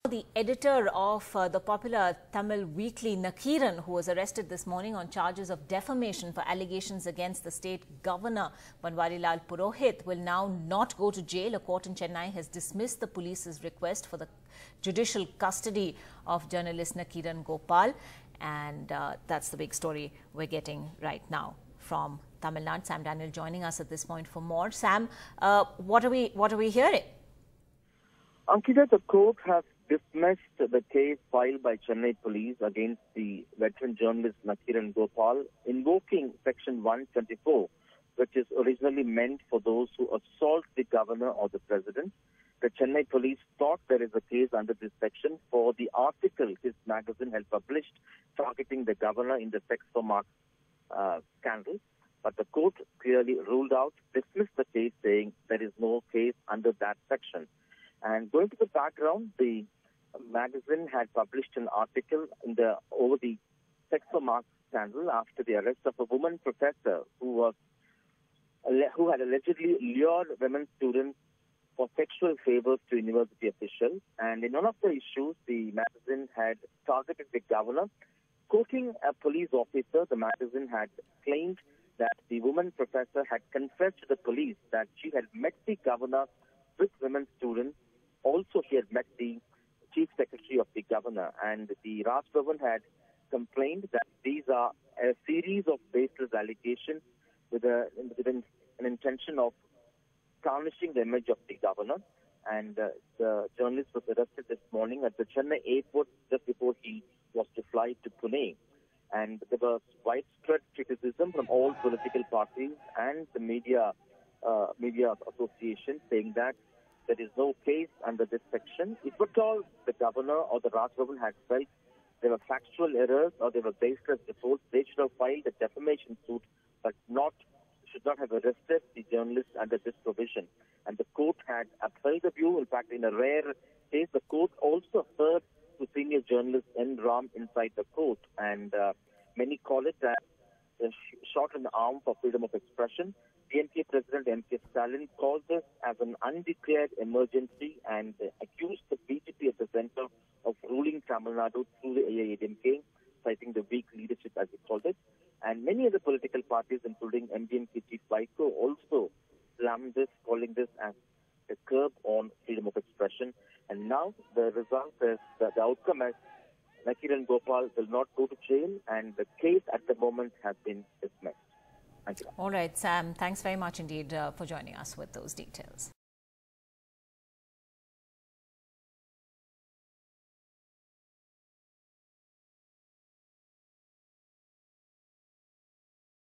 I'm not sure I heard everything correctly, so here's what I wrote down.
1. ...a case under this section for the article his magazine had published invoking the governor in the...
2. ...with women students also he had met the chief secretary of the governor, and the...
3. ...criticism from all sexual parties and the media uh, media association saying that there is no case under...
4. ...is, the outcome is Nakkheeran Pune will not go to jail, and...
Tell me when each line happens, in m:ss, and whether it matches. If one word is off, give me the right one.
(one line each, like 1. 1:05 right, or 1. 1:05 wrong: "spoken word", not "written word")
1. 0:44 wrong: "targeting", not "invoking"
2. 1:26 right
3. 1:50 wrong: "political", not "sexual"
4. 2:45 wrong: "Gopal", not "Pune".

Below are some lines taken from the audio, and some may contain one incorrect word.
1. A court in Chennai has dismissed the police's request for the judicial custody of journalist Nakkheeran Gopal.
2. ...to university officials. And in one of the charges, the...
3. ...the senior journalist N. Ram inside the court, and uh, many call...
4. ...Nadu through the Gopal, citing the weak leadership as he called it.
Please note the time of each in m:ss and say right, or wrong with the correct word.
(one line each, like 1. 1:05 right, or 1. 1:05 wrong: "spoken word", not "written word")
1. 0:11 right
2. 1:12 wrong: "issues", not "charges"
3. 2:15 right
4. 2:31 wrong: "AIADMK", not "Gopal".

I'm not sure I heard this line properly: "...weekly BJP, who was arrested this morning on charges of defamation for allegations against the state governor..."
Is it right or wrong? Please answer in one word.
wrong.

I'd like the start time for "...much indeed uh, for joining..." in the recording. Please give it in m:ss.
2:53.